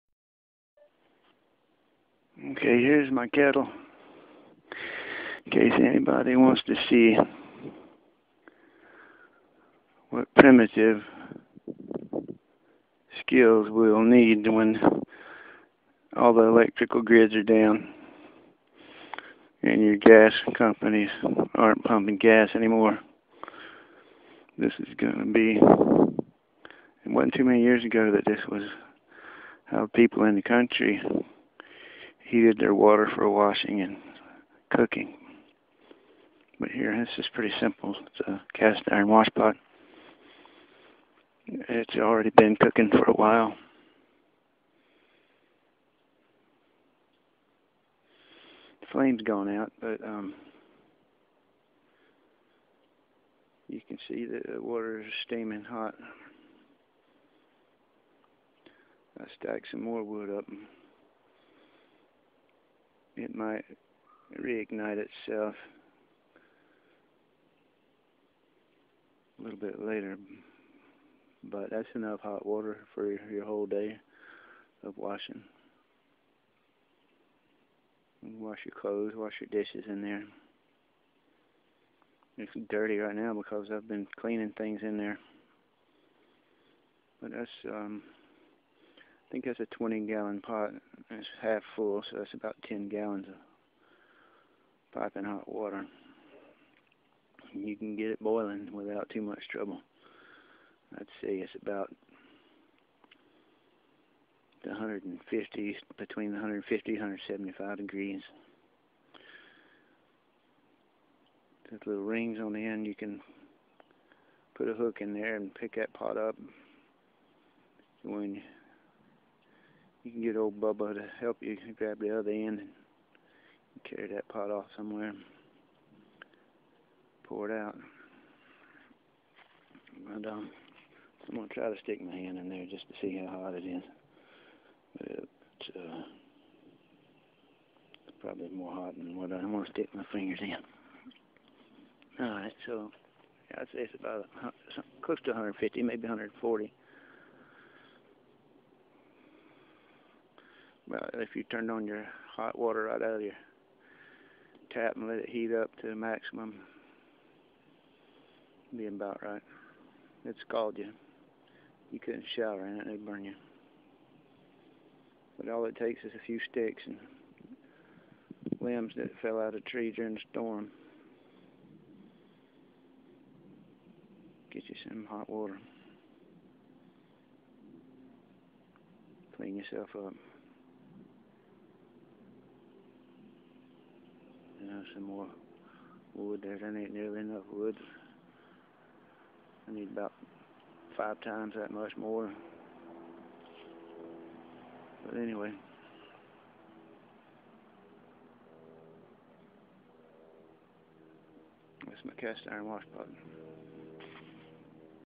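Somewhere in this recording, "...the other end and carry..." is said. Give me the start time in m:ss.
2:01.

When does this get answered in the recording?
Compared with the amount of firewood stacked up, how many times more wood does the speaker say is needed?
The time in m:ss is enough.
3:10.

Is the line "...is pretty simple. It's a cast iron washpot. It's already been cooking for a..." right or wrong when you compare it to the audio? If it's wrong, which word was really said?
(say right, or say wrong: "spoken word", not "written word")
right.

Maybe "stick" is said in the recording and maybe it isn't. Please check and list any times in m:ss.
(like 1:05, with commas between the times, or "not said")
2:11, 2:19, 2:46.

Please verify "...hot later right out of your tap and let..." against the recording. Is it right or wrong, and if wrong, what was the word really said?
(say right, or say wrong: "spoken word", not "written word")
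wrong: "water", not "later".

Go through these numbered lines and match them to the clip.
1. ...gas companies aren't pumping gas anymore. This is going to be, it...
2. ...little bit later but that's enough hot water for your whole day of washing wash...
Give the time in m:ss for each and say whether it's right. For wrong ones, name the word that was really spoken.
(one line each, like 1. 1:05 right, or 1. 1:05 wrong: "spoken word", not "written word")
1. 0:19 right
2. 1:09 right.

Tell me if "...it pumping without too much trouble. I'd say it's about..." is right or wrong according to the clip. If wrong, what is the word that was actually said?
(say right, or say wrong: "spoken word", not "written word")
wrong: "boiling", not "pumping".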